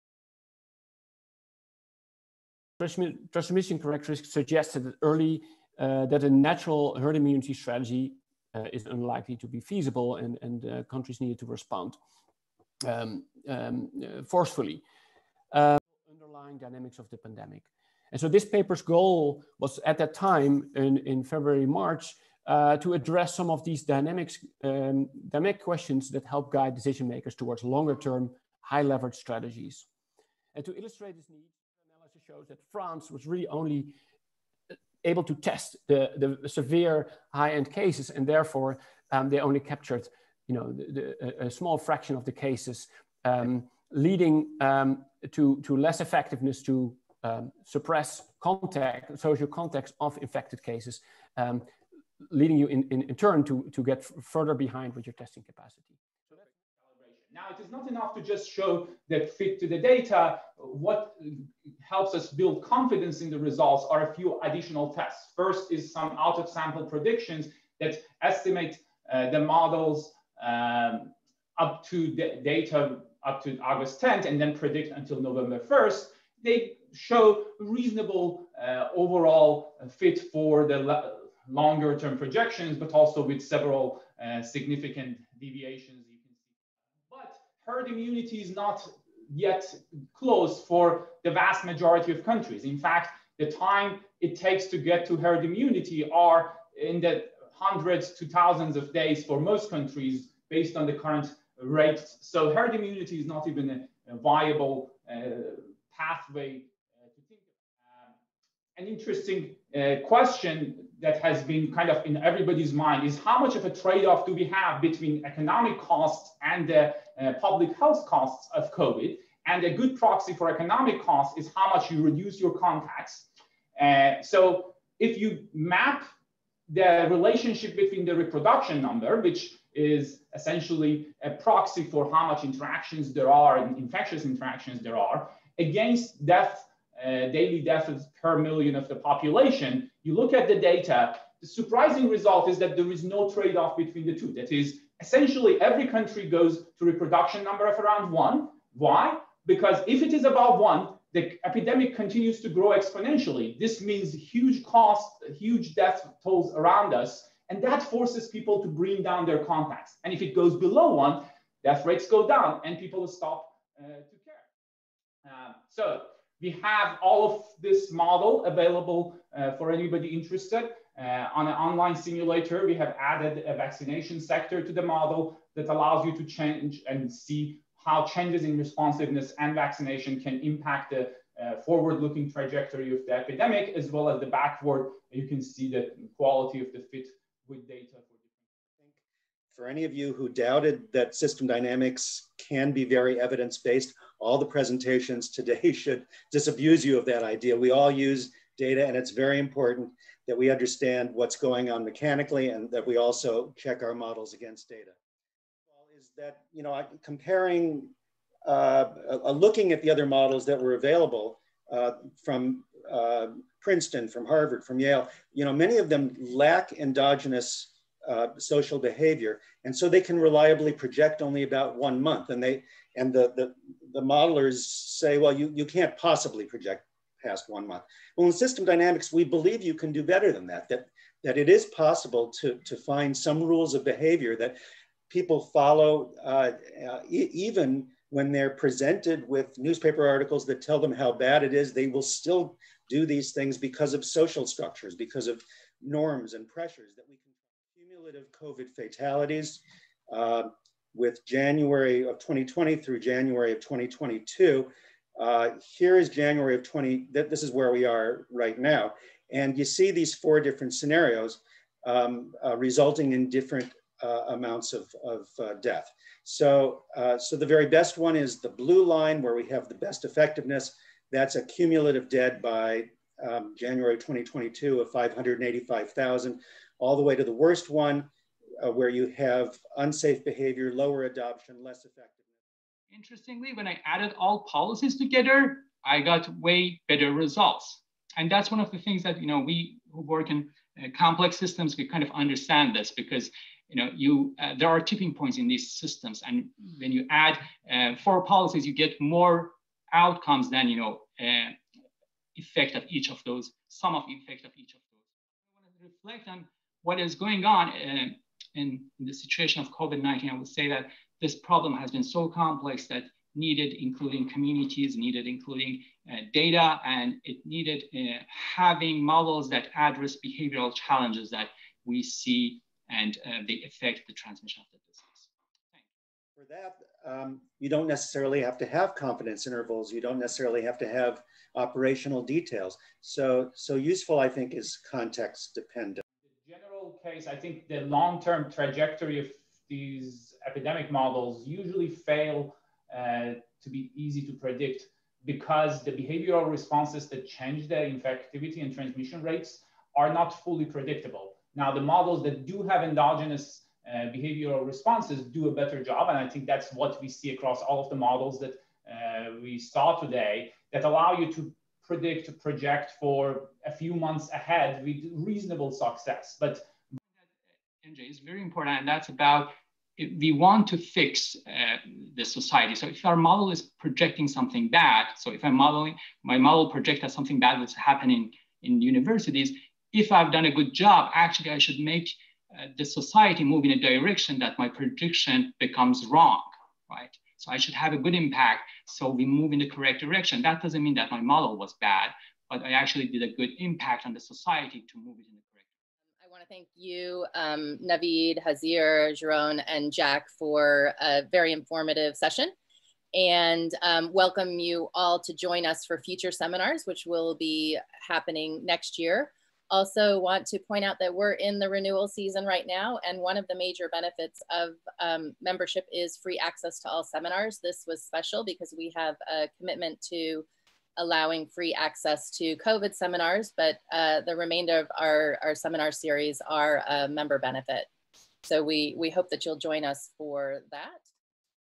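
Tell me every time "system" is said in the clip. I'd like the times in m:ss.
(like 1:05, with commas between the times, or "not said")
3:11, 3:48, 4:51, 4:55.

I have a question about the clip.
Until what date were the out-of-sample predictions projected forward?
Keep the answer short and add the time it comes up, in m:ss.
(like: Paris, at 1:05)
November 1st, at 1:15.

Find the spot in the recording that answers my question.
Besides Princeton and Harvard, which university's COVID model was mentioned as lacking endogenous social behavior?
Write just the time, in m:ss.
3:34.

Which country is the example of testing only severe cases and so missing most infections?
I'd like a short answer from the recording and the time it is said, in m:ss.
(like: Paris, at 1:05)
France, at 0:32.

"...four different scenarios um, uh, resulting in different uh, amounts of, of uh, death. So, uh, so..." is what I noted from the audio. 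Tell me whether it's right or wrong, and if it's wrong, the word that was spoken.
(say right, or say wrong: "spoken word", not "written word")
right.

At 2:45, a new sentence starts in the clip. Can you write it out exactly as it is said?
Uh, so we have all of this model available uh, for anybody interested.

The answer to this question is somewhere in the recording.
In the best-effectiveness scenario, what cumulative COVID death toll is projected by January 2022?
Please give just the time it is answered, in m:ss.
4:34.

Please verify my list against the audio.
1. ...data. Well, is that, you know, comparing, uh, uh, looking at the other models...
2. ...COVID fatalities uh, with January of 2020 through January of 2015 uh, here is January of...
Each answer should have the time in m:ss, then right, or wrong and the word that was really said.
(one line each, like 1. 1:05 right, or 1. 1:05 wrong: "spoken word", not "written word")
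1. 3:24 right
2. 4:08 wrong: "2022", not "2015".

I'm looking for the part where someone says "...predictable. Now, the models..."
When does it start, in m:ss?
5:50.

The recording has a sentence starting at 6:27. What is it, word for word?
So I should have a good impact.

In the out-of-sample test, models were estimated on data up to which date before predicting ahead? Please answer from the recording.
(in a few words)
August 10th.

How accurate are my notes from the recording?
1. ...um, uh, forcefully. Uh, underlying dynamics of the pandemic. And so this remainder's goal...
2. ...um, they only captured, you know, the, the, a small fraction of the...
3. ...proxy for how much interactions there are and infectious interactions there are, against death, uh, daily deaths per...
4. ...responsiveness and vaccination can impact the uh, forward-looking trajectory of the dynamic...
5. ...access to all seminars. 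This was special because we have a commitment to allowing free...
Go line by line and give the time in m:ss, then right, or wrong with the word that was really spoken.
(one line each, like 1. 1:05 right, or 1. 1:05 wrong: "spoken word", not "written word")
1. 0:13 wrong: "paper", not "remainder"
2. 0:39 right
3. 2:11 right
4. 2:58 wrong: "epidemic", not "dynamic"
5. 6:56 right.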